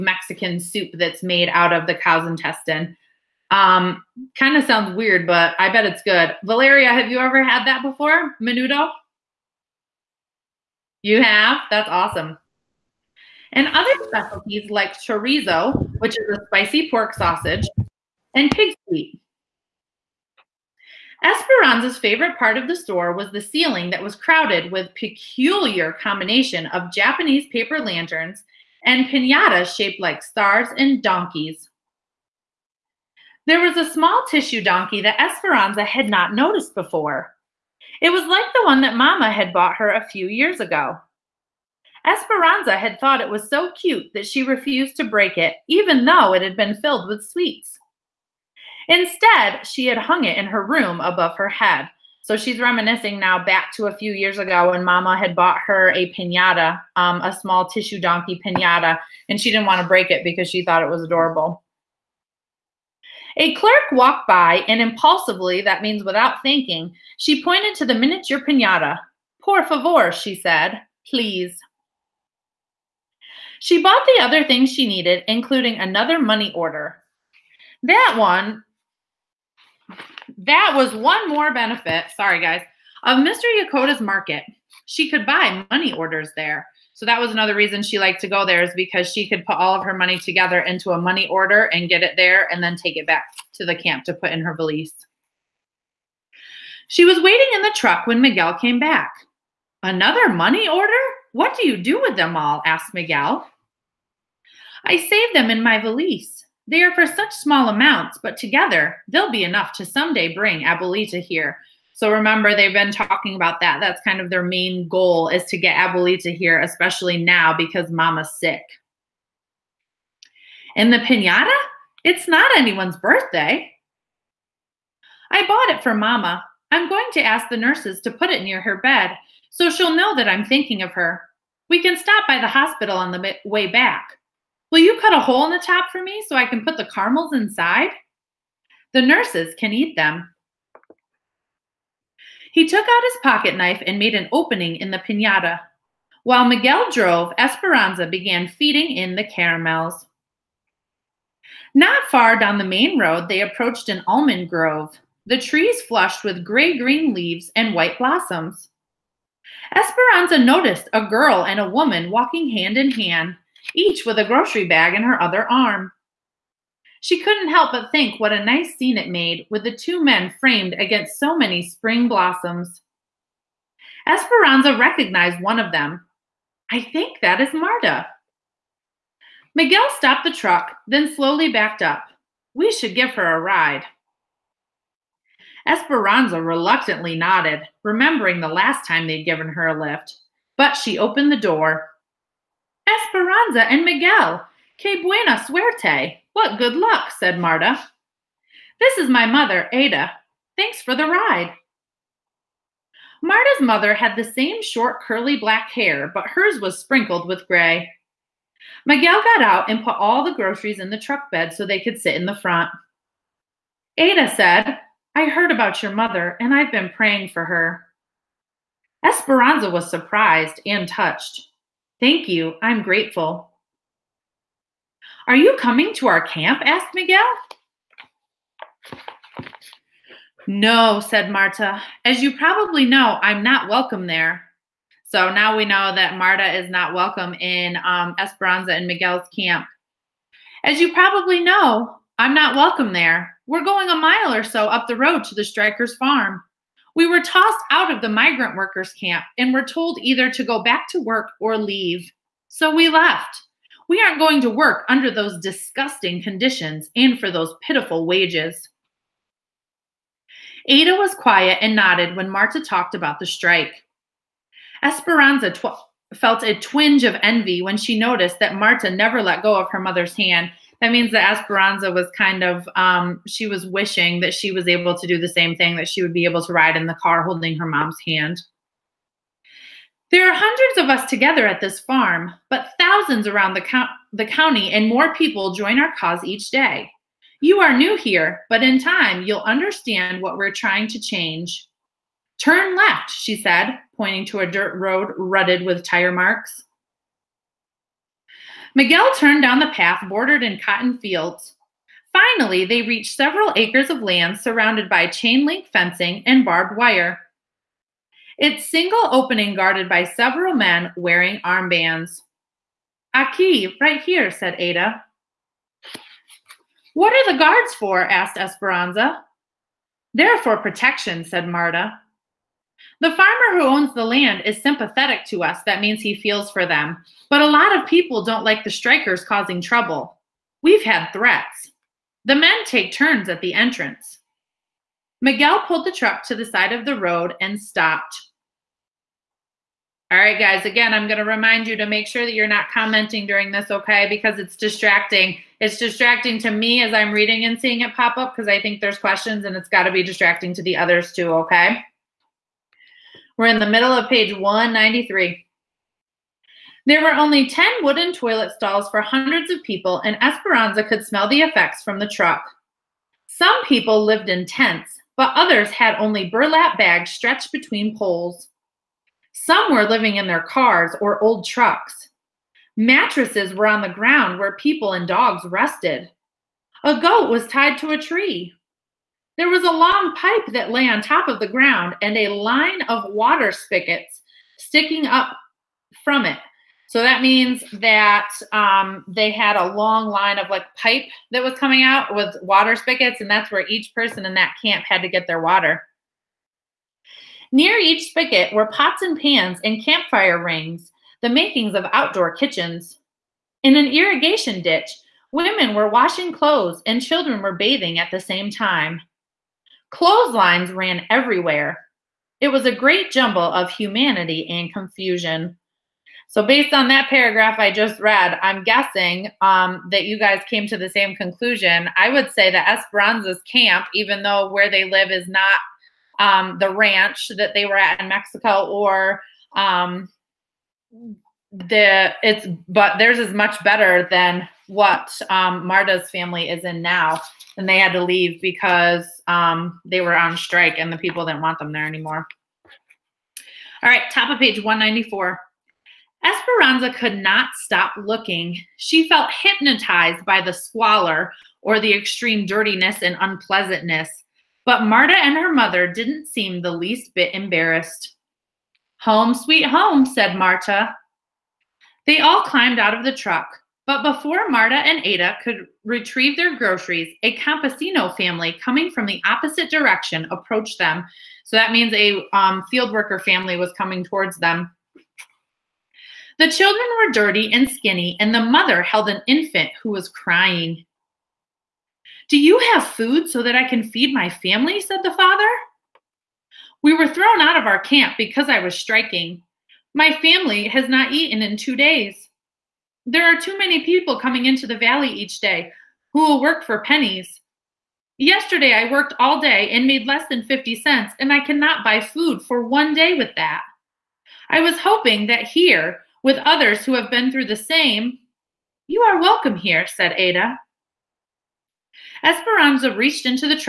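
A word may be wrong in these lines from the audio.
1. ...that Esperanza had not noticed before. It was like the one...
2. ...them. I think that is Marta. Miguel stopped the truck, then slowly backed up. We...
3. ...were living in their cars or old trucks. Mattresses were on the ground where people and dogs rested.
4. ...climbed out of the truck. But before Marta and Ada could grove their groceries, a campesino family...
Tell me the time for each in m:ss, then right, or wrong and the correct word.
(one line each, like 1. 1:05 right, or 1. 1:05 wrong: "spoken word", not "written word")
1. 0:35 right
2. 2:55 right
3. 6:09 right
4. 7:42 wrong: "retrieve", not "grove".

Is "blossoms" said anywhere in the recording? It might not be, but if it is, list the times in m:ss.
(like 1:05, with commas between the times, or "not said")
2:37, 2:52.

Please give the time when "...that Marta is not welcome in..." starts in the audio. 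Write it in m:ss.
3:55.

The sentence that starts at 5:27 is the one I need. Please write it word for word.
But a lot of people don't like the strikers causing trouble.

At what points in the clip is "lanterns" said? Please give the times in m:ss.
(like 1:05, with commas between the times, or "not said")
0:27.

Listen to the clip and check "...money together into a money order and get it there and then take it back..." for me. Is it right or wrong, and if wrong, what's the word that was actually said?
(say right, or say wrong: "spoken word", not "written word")
right.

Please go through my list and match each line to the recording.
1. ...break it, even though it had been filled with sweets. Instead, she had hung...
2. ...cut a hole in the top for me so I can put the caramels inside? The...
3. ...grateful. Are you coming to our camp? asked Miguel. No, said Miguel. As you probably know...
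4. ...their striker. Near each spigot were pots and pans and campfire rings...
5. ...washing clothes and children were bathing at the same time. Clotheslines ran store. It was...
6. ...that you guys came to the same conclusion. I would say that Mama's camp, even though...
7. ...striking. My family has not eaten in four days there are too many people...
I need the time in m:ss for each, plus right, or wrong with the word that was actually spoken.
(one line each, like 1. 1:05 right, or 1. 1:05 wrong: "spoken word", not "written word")
1. 0:45 right
2. 2:15 right
3. 3:42 wrong: "Marta", not "Miguel"
4. 6:35 wrong: "water", not "striker"
5. 6:45 wrong: "everywhere", not "store"
6. 6:59 wrong: "Esperanza", not "Mama"
7. 8:08 wrong: "two", not "four".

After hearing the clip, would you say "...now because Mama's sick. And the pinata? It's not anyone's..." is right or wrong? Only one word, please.
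right.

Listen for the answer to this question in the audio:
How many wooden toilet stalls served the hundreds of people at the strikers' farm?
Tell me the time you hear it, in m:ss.
5:57.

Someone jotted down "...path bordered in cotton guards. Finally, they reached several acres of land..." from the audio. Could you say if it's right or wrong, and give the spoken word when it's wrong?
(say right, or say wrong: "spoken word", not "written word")
wrong: "fields", not "guards".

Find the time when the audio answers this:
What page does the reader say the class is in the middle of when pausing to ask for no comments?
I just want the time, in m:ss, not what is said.
5:54.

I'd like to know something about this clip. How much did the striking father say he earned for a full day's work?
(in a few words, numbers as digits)
less than 50 cents.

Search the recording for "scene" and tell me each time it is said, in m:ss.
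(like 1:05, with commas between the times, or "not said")
2:48.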